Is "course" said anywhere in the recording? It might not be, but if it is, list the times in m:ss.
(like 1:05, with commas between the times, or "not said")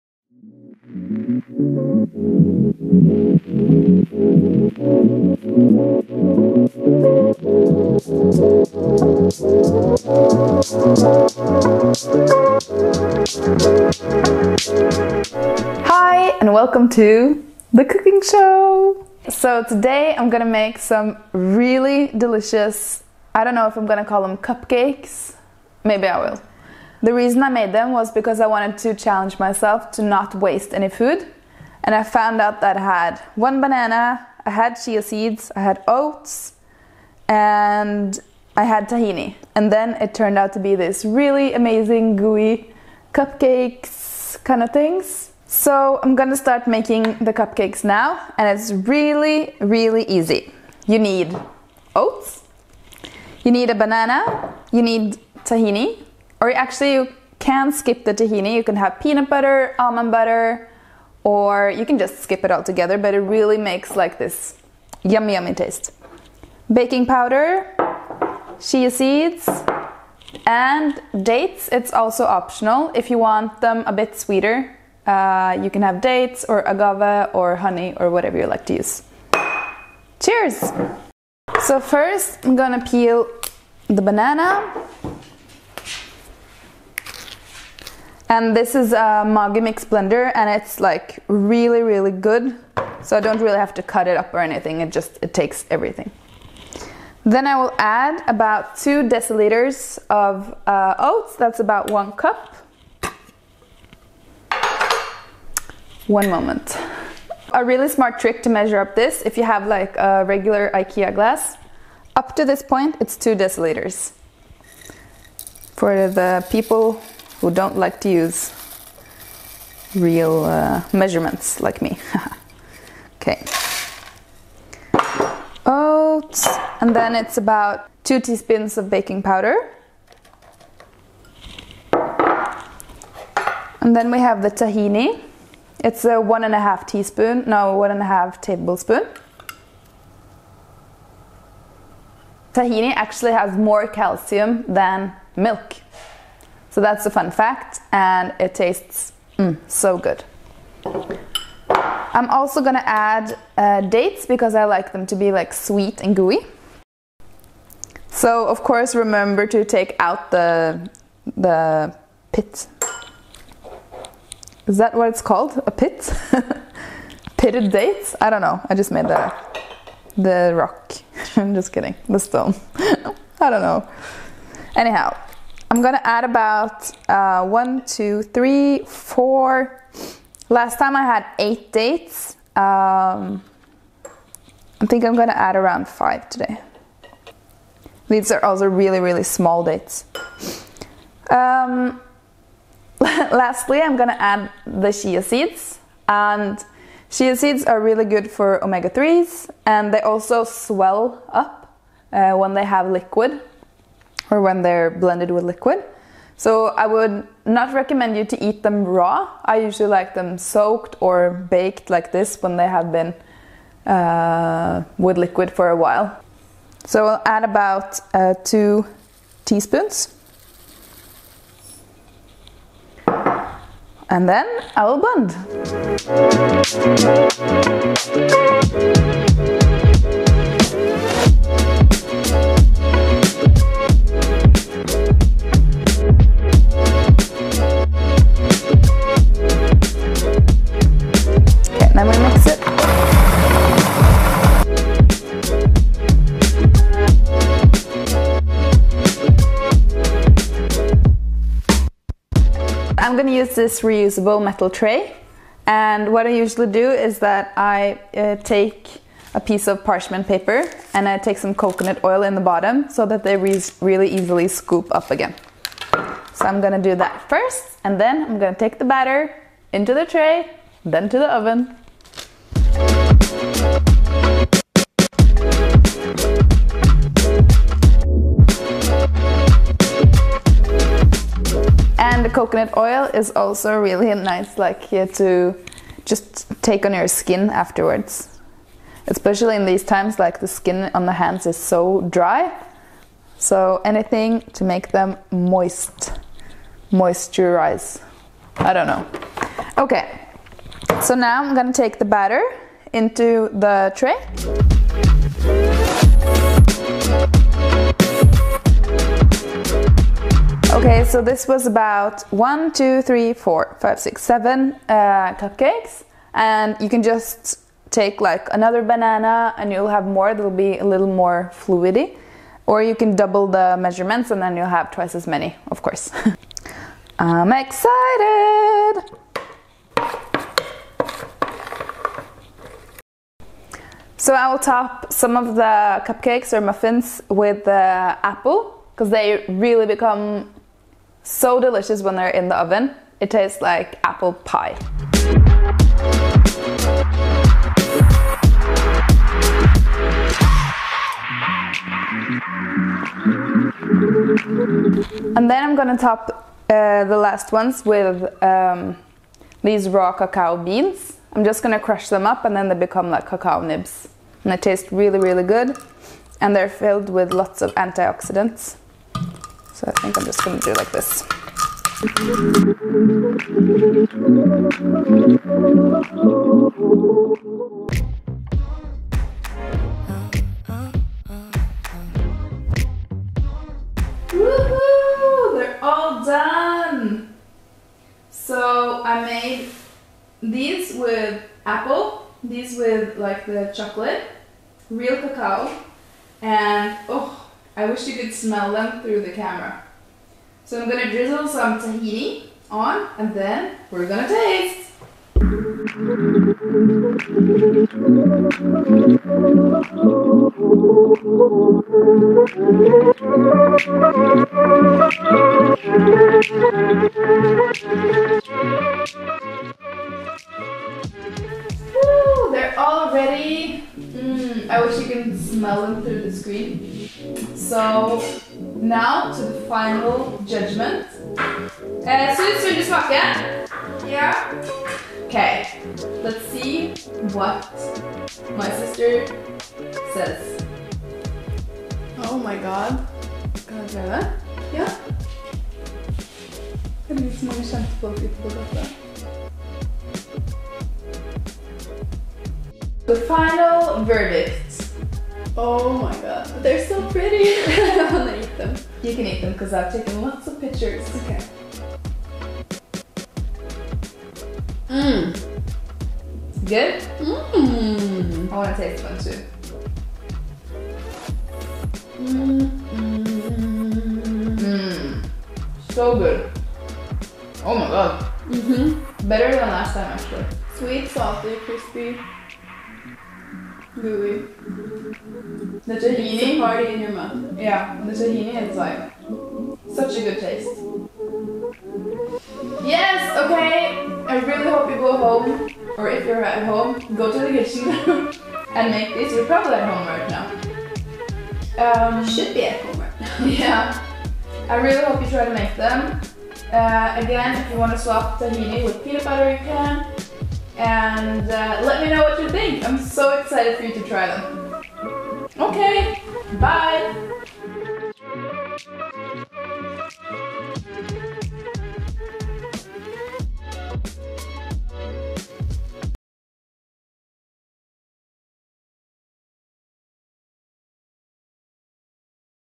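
2:38, 5:25.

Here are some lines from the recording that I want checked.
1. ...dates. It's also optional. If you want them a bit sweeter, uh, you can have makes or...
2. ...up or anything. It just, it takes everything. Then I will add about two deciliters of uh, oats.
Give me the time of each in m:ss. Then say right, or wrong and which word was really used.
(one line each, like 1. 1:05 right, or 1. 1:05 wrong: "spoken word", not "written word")
1. 1:11 wrong: "dates", not "makes"
2. 1:34 right.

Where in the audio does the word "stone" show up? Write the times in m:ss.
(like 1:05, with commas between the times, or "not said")
2:52.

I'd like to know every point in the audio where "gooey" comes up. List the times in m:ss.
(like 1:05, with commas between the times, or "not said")
0:42, 2:36.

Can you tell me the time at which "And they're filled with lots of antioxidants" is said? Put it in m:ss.
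6:06.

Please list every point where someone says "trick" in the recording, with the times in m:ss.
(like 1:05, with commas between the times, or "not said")
1:48.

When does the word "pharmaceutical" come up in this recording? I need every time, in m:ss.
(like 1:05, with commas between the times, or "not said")
not said.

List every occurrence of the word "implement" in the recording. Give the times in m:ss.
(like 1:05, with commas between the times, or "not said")
not said.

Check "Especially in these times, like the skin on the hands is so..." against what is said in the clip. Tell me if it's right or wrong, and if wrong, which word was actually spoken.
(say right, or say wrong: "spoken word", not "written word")
right.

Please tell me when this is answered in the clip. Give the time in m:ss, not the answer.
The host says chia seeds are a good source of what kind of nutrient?
3:18.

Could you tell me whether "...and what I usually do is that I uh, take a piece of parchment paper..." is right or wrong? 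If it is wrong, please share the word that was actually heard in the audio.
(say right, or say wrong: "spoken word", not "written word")
right.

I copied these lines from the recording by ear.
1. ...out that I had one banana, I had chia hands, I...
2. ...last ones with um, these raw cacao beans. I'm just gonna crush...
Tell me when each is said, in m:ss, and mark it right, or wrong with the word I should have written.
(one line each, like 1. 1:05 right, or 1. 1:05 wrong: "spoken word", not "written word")
1. 0:32 wrong: "seeds", not "hands"
2. 5:57 right.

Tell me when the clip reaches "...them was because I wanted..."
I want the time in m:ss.
0:27.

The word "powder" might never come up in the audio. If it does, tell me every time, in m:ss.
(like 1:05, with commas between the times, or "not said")
1:07, 2:09.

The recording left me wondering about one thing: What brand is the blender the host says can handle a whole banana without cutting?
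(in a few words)
Magimix.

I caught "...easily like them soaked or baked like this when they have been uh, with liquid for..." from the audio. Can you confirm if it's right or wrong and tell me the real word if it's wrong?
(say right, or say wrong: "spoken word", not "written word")
wrong: "usually", not "easily".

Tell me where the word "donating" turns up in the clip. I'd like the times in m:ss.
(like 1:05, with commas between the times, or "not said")
not said.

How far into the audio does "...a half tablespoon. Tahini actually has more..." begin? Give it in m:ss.
2:18.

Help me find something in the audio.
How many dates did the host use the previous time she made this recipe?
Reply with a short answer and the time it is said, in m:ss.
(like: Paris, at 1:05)
8, at 3:01.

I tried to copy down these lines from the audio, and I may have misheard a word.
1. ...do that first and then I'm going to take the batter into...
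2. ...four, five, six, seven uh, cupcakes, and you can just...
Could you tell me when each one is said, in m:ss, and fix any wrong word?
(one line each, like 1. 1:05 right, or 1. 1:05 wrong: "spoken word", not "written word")
1. 4:26 right
2. 5:13 right.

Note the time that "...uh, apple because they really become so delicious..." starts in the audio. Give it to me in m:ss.
5:37.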